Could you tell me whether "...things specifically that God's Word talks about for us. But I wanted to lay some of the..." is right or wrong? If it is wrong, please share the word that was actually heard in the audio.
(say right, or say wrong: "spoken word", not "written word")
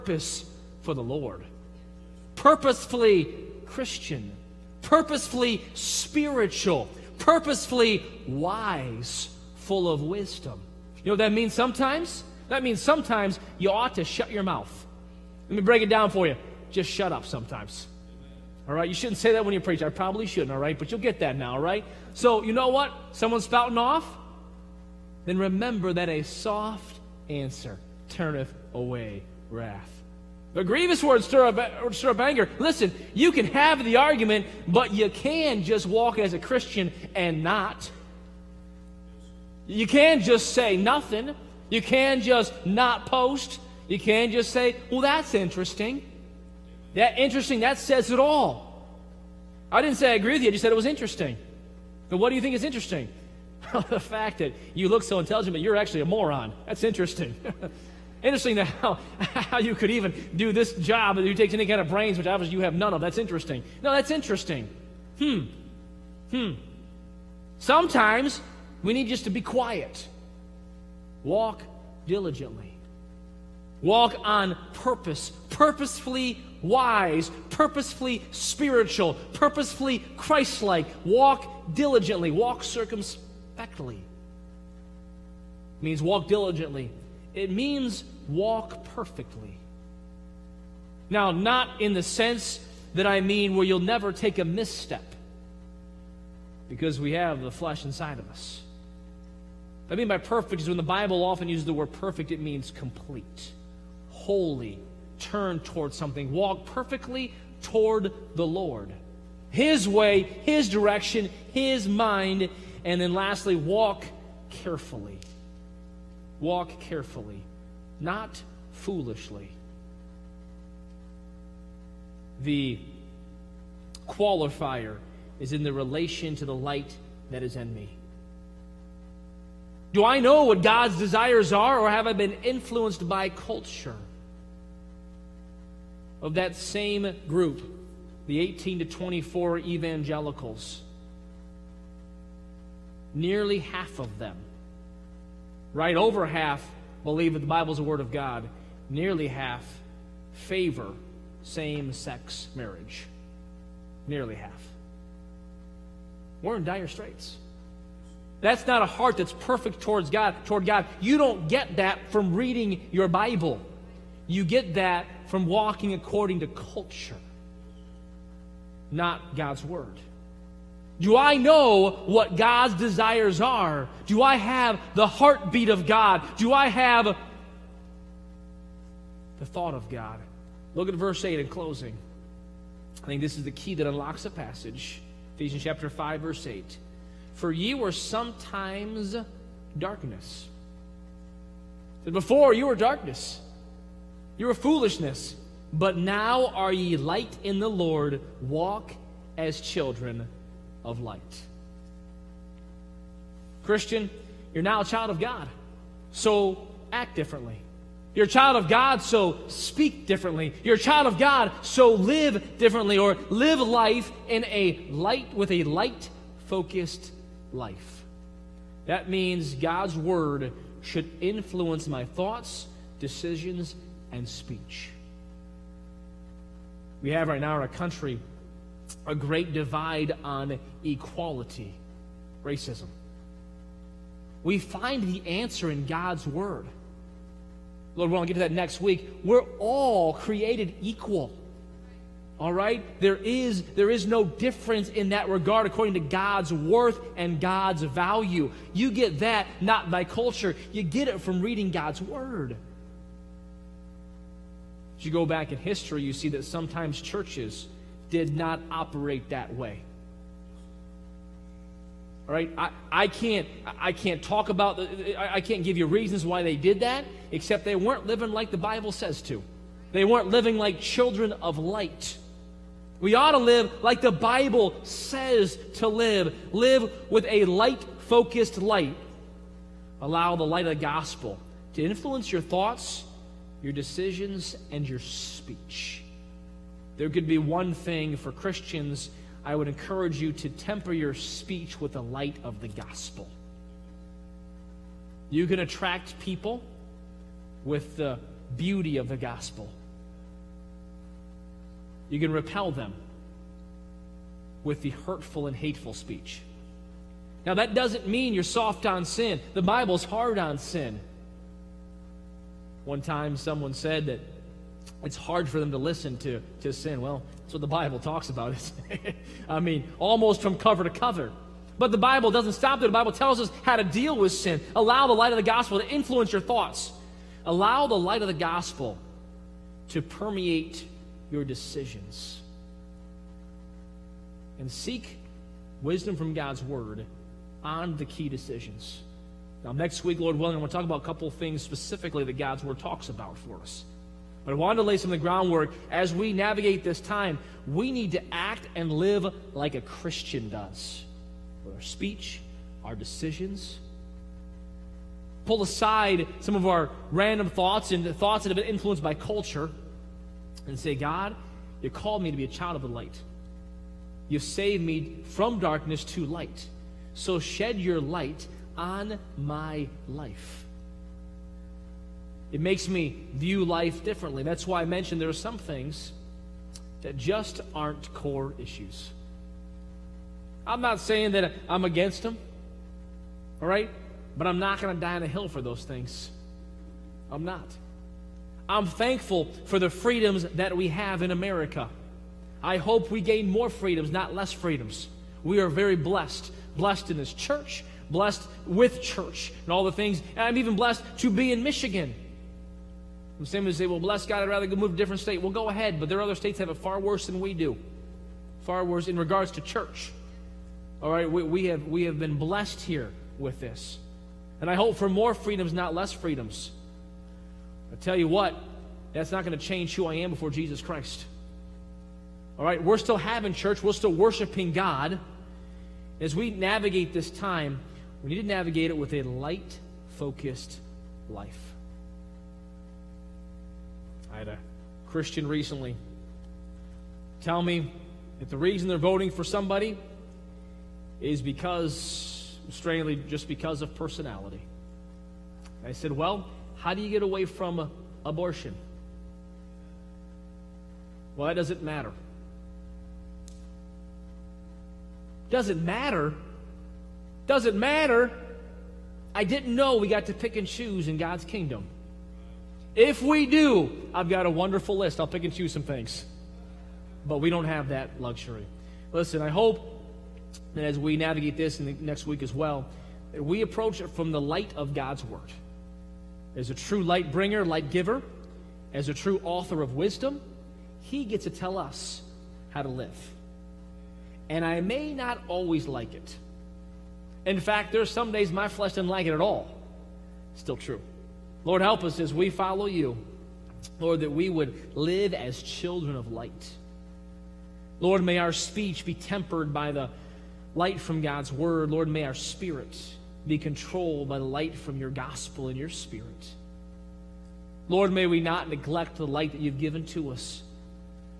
right.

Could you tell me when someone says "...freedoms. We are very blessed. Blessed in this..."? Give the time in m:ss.
6:34.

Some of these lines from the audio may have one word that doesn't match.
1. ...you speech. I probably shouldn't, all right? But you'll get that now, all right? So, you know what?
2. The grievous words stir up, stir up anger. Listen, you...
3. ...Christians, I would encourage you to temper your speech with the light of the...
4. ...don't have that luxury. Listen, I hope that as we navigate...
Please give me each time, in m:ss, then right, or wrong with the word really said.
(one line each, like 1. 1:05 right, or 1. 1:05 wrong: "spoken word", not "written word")
1. 0:19 wrong: "preach", not "speech"
2. 0:30 right
3. 4:48 right
4. 7:47 right.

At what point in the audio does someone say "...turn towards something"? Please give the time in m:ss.
1:45.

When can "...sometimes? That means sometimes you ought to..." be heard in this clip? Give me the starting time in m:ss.
0:11.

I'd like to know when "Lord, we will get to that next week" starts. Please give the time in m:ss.
3:57.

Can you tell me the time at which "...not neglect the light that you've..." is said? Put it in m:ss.
8:28.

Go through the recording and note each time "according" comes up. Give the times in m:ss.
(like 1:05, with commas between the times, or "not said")
2:45, 4:05.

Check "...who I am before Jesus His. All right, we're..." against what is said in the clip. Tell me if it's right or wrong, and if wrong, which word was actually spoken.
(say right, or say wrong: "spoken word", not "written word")
wrong: "Christ", not "His".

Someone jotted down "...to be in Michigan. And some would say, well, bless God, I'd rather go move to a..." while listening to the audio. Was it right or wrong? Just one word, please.
right.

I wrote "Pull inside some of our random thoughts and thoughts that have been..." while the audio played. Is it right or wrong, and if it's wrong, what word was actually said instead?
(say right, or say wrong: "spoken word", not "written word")
wrong: "aside", not "inside".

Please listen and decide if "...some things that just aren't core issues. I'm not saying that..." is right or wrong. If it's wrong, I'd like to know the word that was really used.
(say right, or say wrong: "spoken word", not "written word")
right.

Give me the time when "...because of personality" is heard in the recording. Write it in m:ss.
7:23.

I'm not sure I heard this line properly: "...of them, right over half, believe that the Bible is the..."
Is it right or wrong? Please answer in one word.
right.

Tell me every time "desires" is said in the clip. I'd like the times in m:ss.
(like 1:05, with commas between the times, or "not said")
2:10, 2:52.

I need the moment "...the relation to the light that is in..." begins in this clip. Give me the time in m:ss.
2:05.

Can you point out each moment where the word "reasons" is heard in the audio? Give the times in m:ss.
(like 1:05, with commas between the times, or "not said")
4:25, 7:18.